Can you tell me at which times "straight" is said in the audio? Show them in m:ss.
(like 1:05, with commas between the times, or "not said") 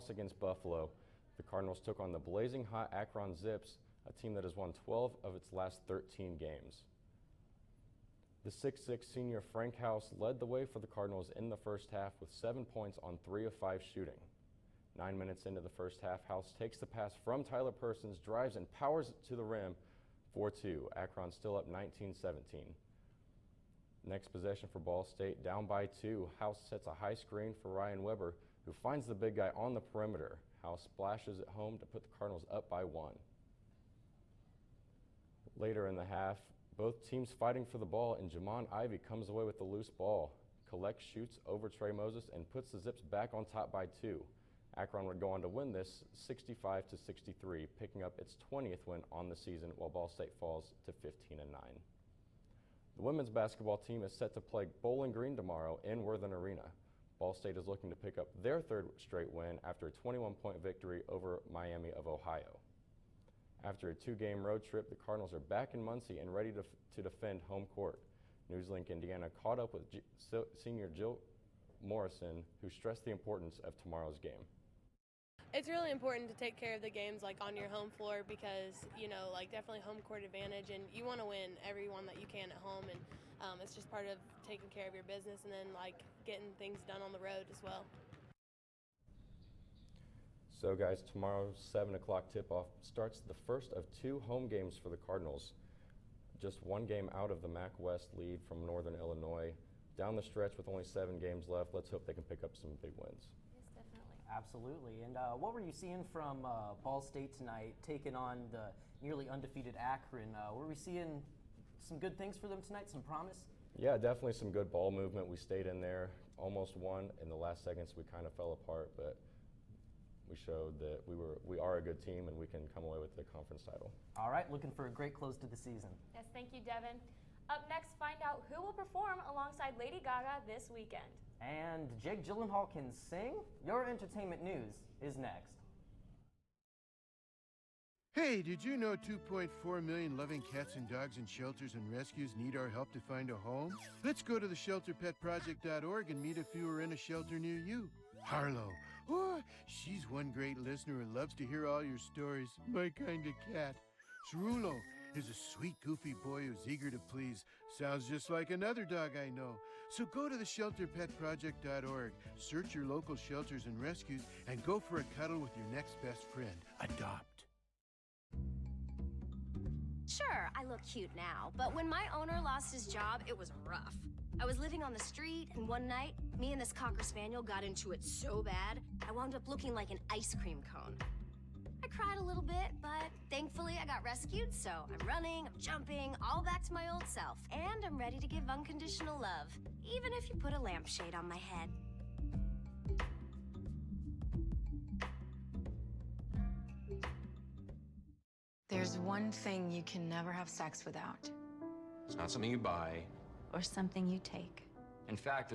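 0:58.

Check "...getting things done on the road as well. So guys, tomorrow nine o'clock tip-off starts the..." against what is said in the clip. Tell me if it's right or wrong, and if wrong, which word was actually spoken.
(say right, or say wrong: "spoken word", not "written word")
wrong: "seven", not "nine".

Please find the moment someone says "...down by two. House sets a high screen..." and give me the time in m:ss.
0:25.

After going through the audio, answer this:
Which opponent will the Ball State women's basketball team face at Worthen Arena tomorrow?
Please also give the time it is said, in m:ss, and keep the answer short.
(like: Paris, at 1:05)
Bowling Green, at 0:54.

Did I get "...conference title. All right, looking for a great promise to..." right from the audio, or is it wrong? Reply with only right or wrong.
wrong.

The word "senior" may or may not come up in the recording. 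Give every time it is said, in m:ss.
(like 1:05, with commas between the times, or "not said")
0:09, 1:10.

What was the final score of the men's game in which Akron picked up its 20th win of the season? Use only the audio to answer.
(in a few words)
65 to 63.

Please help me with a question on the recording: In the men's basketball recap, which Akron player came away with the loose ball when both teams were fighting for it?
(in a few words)
Jimond Ivey.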